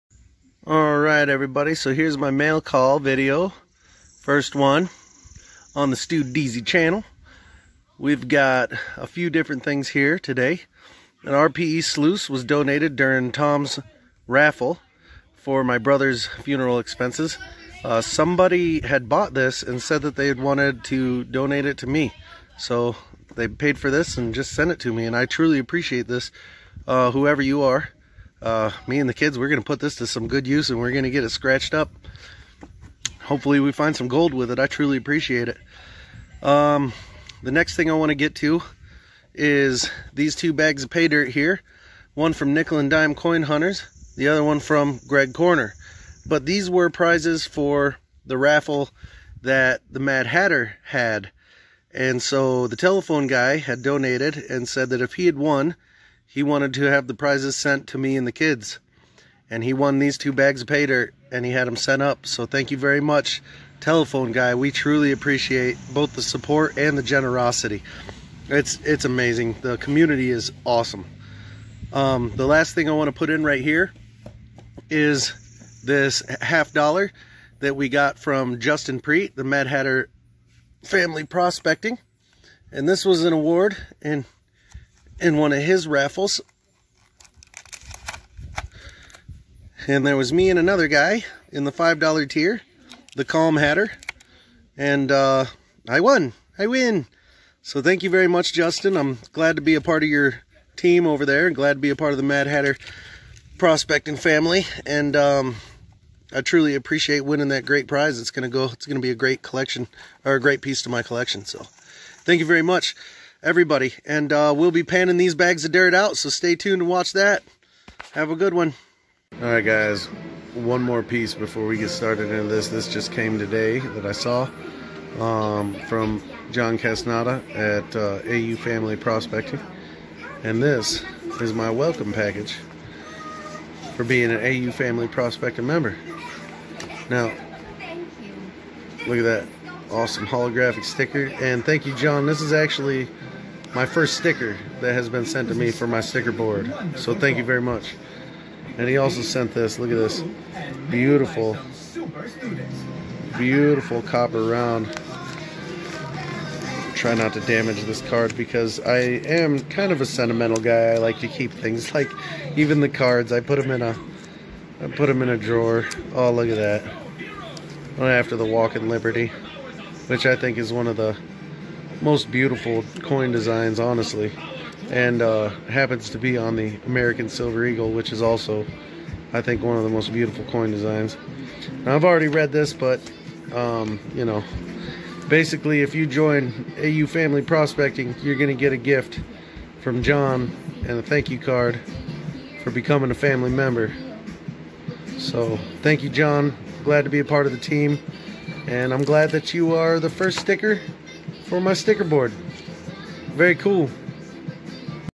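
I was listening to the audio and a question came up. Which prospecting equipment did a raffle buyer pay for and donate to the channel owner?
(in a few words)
RPE sluice.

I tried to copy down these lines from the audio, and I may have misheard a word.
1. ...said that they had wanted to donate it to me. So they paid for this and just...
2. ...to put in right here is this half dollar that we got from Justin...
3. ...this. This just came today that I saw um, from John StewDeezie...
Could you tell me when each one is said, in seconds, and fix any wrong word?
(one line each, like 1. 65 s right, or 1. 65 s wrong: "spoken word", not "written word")
1. 19 s right
2. 73 s right
3. 122 s wrong: "Casnada", not "StewDeezie".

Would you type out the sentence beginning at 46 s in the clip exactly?
But these were prizes for the raffle that the Mad Hatter had.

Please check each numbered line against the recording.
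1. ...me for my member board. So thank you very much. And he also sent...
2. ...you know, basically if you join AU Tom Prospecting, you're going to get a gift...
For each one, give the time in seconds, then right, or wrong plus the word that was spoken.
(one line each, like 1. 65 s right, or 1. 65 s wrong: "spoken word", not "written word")
1. 145 s wrong: "sticker", not "member"
2. 184 s wrong: "Family", not "Tom".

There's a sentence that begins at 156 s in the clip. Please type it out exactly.
Try not to damage this card because I am kind of a sentimental guy.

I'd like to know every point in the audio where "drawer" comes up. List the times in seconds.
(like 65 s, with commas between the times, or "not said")
165 s.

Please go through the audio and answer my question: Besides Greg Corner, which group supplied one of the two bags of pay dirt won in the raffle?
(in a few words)
Nickel and Dime Coin Hunters.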